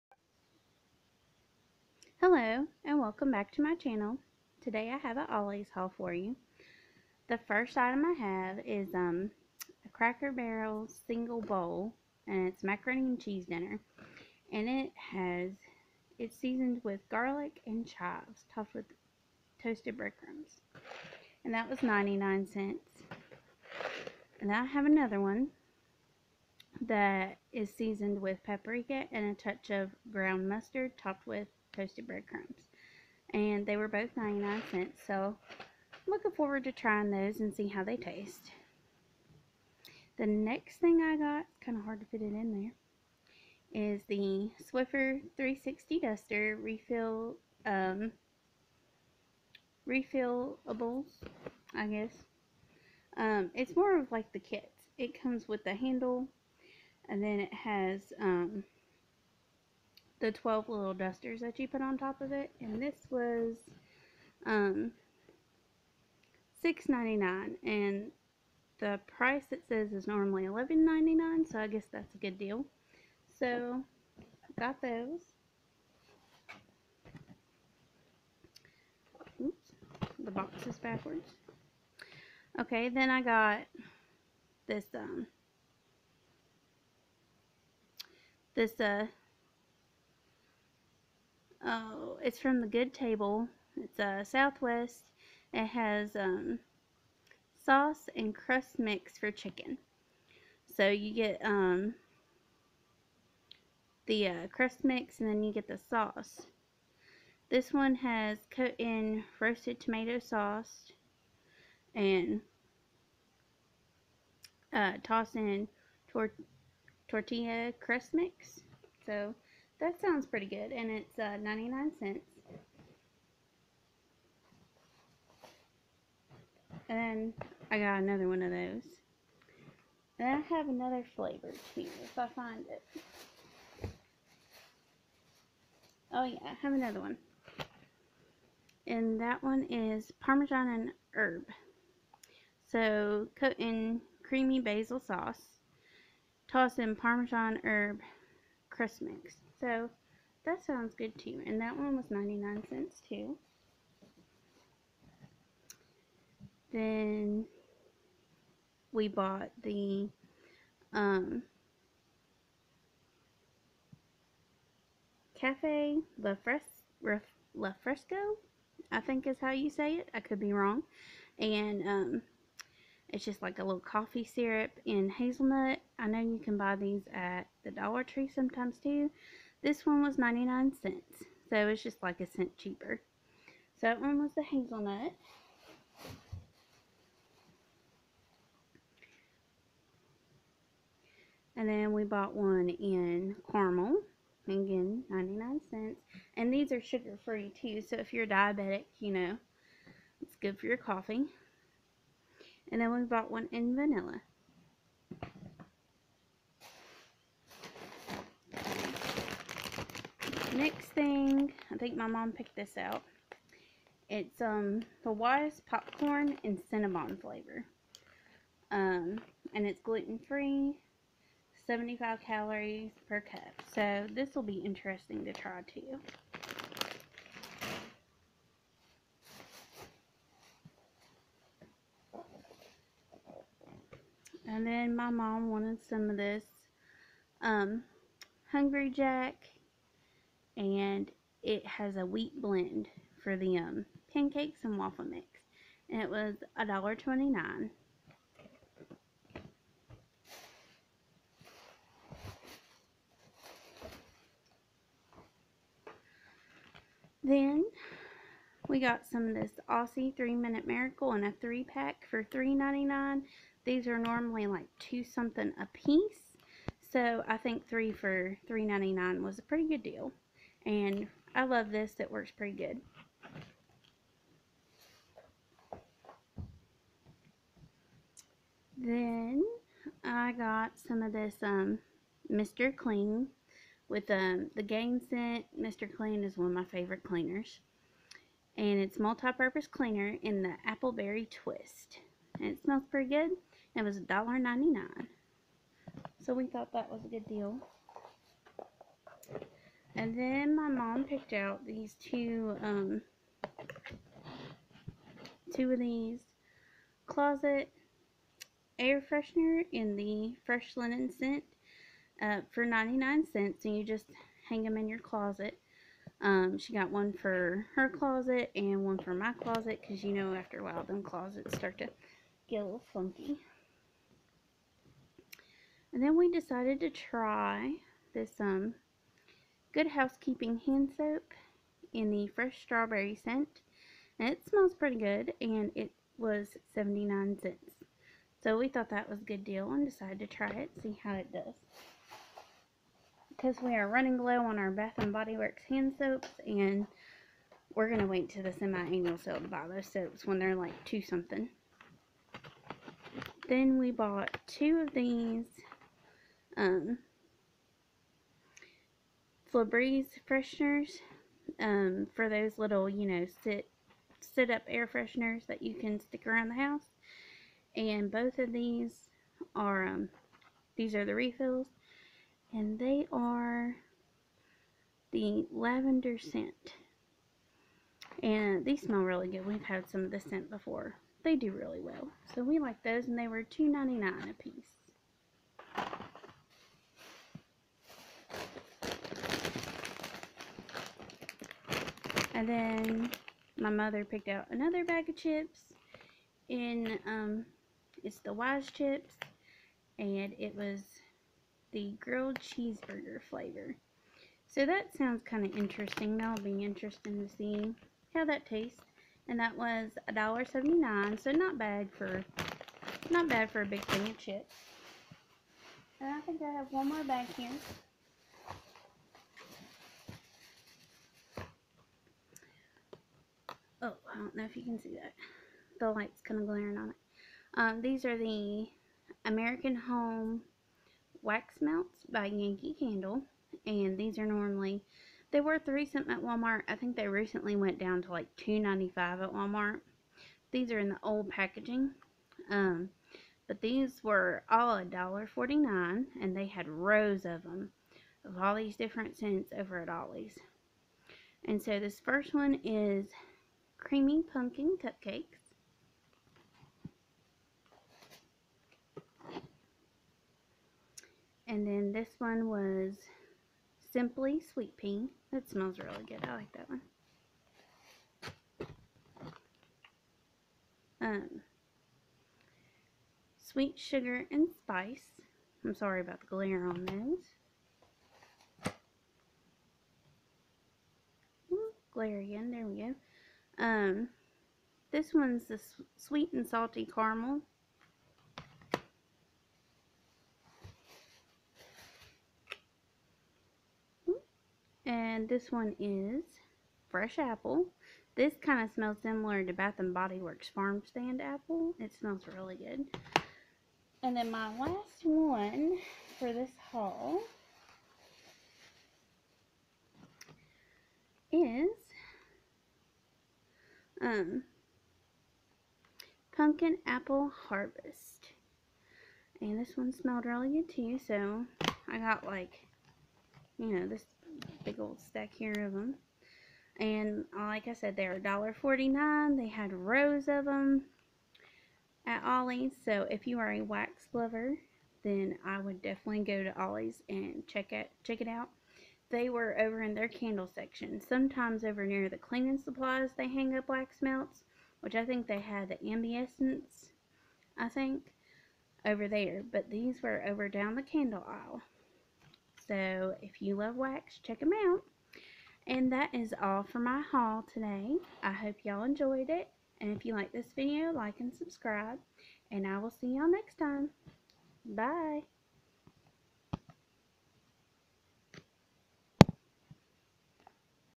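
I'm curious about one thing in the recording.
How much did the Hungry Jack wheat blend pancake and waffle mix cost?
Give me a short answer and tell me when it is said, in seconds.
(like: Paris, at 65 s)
$1.29, at 246 s.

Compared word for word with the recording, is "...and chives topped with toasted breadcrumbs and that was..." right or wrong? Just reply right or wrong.
right.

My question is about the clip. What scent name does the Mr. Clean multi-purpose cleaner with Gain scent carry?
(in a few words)
Appleberry Twist.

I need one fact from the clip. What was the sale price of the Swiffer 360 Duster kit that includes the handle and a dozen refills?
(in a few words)
$6.99.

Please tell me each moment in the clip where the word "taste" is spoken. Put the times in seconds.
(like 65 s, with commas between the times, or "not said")
37 s, 408 s.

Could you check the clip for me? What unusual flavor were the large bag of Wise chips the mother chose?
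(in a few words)
grilled cheeseburger.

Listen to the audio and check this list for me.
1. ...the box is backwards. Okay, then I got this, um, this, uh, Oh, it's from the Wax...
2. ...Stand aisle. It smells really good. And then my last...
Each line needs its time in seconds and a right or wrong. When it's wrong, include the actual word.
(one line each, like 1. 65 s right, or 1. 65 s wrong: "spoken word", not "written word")
1. 80 s wrong: "Good", not "Wax"
2. 500 s wrong: "apple", not "aisle".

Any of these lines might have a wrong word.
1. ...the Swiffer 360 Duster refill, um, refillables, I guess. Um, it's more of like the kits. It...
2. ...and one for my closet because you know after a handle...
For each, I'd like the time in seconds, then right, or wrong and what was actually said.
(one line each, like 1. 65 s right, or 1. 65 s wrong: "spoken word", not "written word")
1. 44 s right
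2. 318 s wrong: "while", not "handle".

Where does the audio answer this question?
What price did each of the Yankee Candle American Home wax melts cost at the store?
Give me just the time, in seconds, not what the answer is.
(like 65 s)
444 s.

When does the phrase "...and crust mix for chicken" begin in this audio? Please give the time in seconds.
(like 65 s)
98 s.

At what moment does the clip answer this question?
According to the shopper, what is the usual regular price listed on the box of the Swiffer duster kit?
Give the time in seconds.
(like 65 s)
70 s.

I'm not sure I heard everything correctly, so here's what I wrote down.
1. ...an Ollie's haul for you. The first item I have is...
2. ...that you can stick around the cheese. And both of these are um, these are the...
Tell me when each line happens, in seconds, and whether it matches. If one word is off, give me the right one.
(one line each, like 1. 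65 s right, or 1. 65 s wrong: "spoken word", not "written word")
1. 5 s right
2. 365 s wrong: "house", not "cheese".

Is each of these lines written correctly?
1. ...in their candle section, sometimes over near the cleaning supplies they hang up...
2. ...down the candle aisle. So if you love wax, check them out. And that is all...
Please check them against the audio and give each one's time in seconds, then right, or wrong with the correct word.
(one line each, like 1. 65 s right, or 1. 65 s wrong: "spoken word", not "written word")
1. 539 s right
2. 550 s right.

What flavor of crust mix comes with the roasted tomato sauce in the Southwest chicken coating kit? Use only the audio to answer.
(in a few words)
tortilla.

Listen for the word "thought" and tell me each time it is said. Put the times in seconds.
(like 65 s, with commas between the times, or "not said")
296 s, 338 s.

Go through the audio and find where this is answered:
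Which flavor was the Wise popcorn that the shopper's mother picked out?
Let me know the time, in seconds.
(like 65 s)
216 s.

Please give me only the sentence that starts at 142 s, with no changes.
So coat in creamy basil sauce.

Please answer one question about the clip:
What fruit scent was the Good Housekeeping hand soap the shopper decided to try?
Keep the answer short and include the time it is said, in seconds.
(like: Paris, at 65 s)
Fresh Strawberry, at 332 s.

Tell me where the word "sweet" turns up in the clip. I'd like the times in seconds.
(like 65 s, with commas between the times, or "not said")
464 s, 473 s, 485 s.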